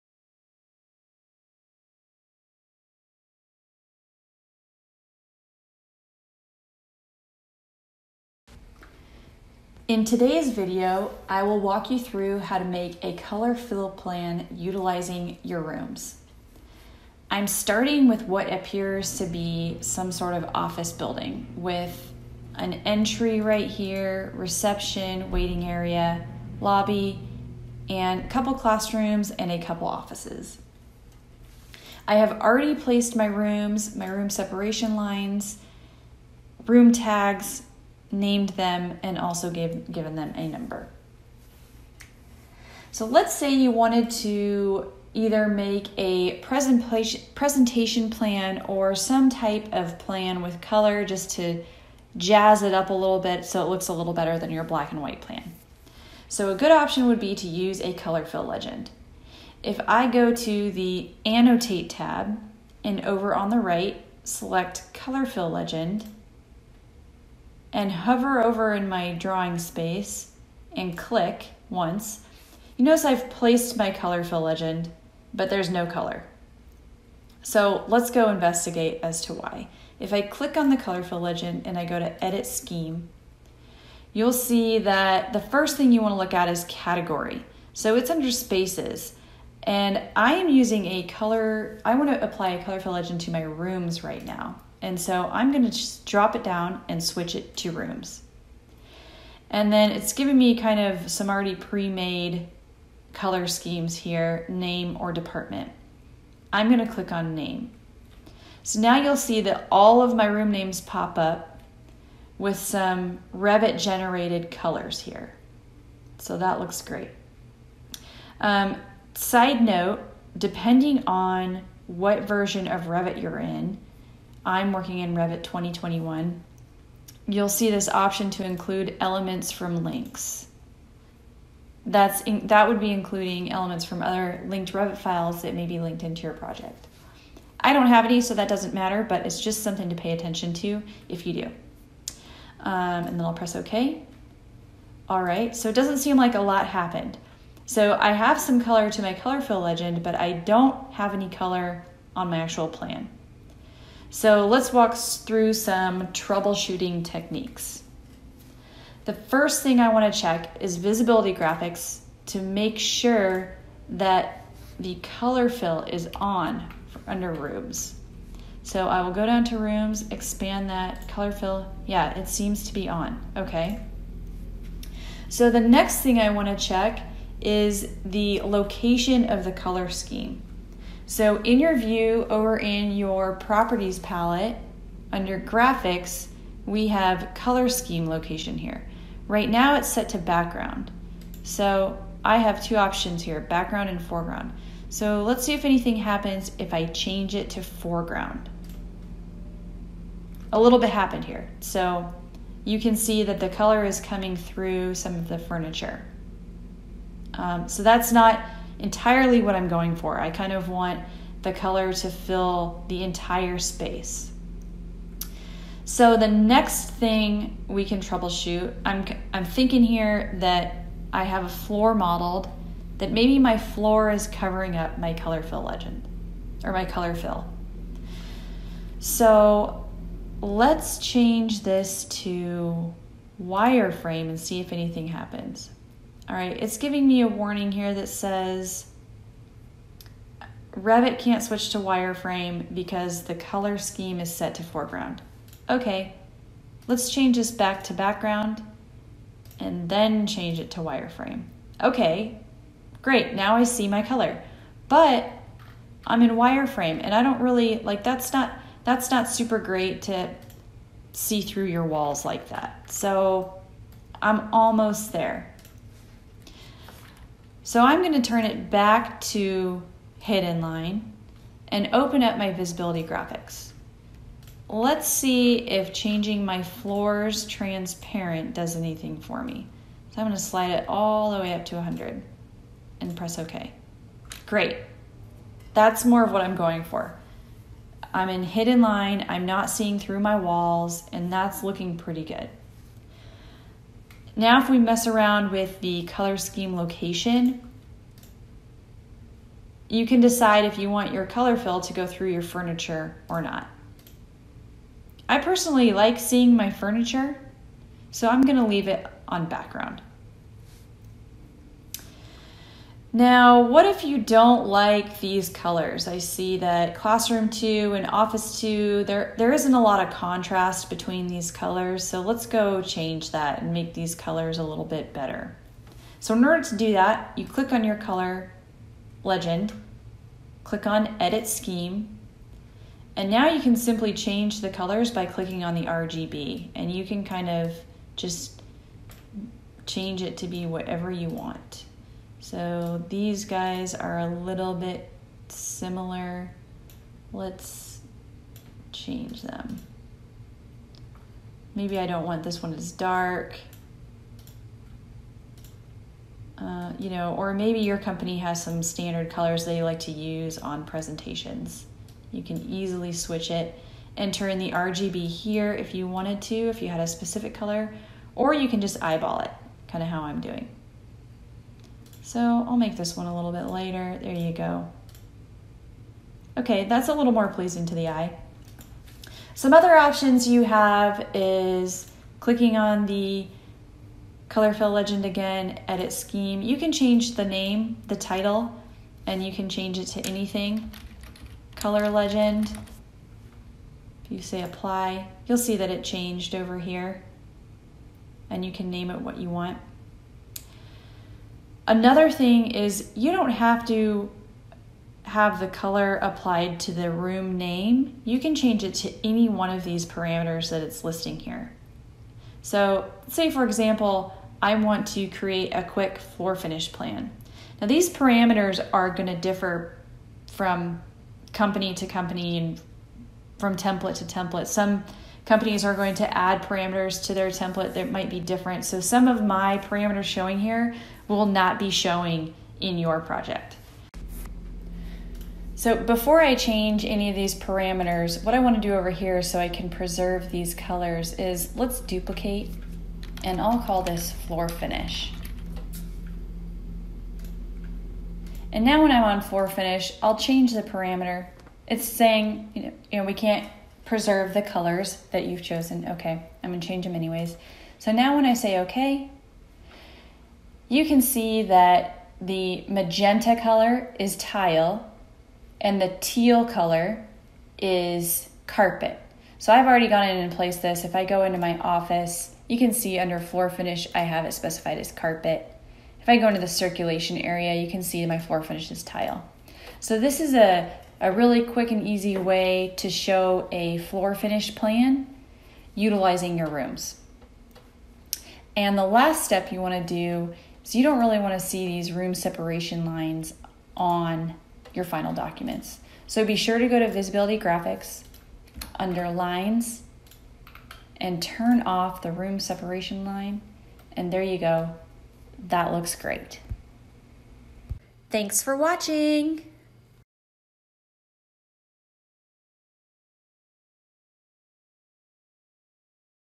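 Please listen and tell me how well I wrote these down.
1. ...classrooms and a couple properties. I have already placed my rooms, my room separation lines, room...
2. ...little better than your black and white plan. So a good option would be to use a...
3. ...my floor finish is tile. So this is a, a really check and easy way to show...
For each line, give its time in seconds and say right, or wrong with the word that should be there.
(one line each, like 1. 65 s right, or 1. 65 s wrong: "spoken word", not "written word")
1. 28 s wrong: "offices", not "properties"
2. 53 s right
3. 478 s wrong: "quick", not "check".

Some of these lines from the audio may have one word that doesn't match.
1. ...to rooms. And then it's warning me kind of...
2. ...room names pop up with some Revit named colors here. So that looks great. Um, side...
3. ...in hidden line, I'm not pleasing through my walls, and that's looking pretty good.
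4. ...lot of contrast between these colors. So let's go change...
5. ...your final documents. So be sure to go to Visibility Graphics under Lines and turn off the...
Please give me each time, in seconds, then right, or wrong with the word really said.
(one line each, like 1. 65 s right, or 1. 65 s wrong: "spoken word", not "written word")
1. 97 s wrong: "giving", not "warning"
2. 110 s wrong: "generated", not "named"
3. 288 s wrong: "seeing", not "pleasing"
4. 319 s right
5. 494 s right.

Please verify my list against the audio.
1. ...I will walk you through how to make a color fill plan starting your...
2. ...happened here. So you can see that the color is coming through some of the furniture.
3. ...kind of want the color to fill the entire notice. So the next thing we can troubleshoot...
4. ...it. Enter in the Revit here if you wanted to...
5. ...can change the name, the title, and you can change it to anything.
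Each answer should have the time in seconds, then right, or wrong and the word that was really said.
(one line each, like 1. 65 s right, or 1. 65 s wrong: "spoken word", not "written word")
1. 11 s wrong: "utilizing", not "starting"
2. 200 s right
3. 210 s wrong: "space", not "notice"
4. 363 s wrong: "RGB", not "Revit"
5. 386 s right.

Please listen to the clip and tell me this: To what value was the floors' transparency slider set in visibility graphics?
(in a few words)
100.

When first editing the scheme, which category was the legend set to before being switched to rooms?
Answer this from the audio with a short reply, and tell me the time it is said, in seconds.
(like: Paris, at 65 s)
spaces, at 88 s.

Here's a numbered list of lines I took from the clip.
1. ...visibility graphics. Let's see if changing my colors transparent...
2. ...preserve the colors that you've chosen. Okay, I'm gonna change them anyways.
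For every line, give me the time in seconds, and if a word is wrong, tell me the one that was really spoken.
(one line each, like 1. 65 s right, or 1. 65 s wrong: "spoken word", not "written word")
1. 272 s wrong: "floors", not "colors"
2. 454 s right.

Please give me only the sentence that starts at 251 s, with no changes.
Okay, great, now I see my color.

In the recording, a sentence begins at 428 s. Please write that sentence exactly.
So some of my parameters showing here will not be showing in your project.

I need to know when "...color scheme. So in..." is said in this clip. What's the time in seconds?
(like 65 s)
179 s.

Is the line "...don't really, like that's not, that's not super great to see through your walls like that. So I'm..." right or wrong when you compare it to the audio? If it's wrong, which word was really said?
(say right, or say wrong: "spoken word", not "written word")
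right.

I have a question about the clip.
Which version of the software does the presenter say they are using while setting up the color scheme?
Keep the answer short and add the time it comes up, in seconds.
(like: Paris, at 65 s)
Revit 2021, at 125 s.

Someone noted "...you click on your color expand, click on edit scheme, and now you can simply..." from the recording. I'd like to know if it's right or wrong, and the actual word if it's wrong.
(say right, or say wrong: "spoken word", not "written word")
wrong: "legend", not "expand".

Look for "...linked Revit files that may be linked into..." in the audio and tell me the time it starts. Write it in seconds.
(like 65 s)
134 s.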